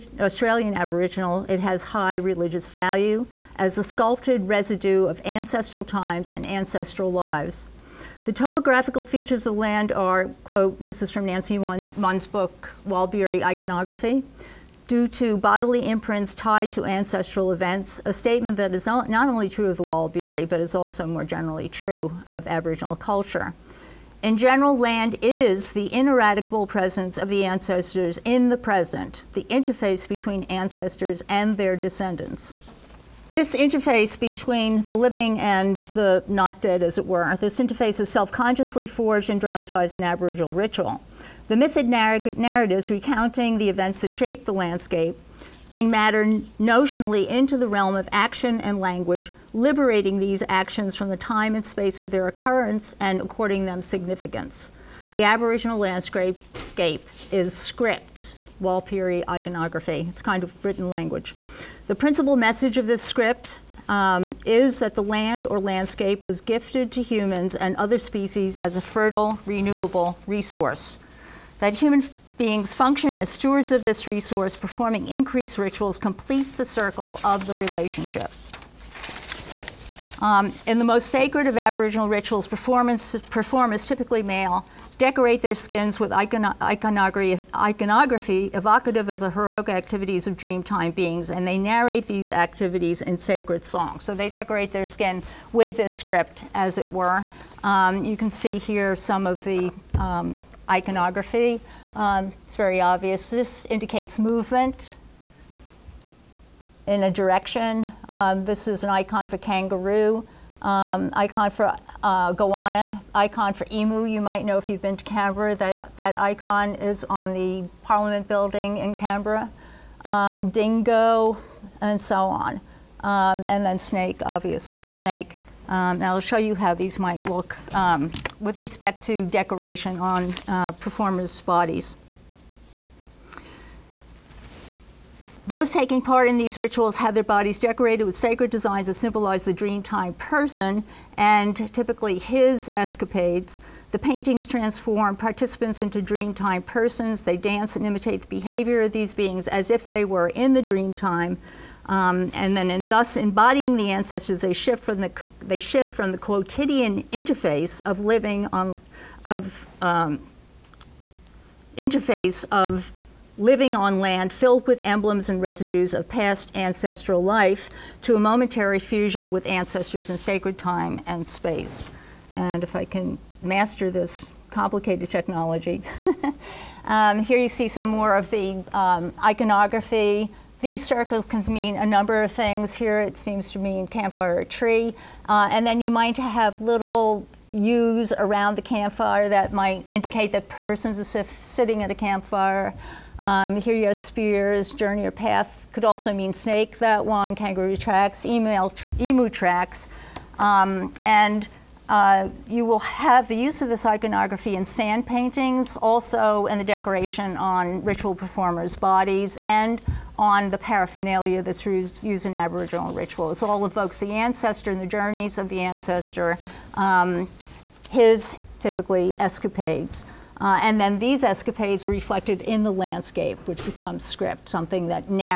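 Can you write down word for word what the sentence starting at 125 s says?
Um, now I'll show you how these might look um, with respect to decoration on uh, performers' bodies.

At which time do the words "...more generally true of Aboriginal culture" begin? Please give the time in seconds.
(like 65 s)
21 s.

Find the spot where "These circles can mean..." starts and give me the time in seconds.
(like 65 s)
180 s.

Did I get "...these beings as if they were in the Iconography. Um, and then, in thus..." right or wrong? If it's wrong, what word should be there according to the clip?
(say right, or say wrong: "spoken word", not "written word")
wrong: "Dreamtime", not "Iconography".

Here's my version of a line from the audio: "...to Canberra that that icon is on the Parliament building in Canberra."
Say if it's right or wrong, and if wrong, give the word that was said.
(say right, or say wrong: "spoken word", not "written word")
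right.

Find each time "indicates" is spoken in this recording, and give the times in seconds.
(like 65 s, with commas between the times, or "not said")
103 s, 189 s.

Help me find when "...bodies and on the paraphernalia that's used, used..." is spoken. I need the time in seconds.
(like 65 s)
208 s.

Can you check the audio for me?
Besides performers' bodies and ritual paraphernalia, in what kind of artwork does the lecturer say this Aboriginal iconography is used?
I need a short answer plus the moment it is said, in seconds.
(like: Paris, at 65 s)
Sand paintings, at 204 s.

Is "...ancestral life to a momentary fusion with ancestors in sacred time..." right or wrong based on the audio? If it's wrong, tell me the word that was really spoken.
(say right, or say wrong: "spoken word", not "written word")
right.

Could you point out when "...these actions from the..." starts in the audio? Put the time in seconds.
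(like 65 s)
50 s.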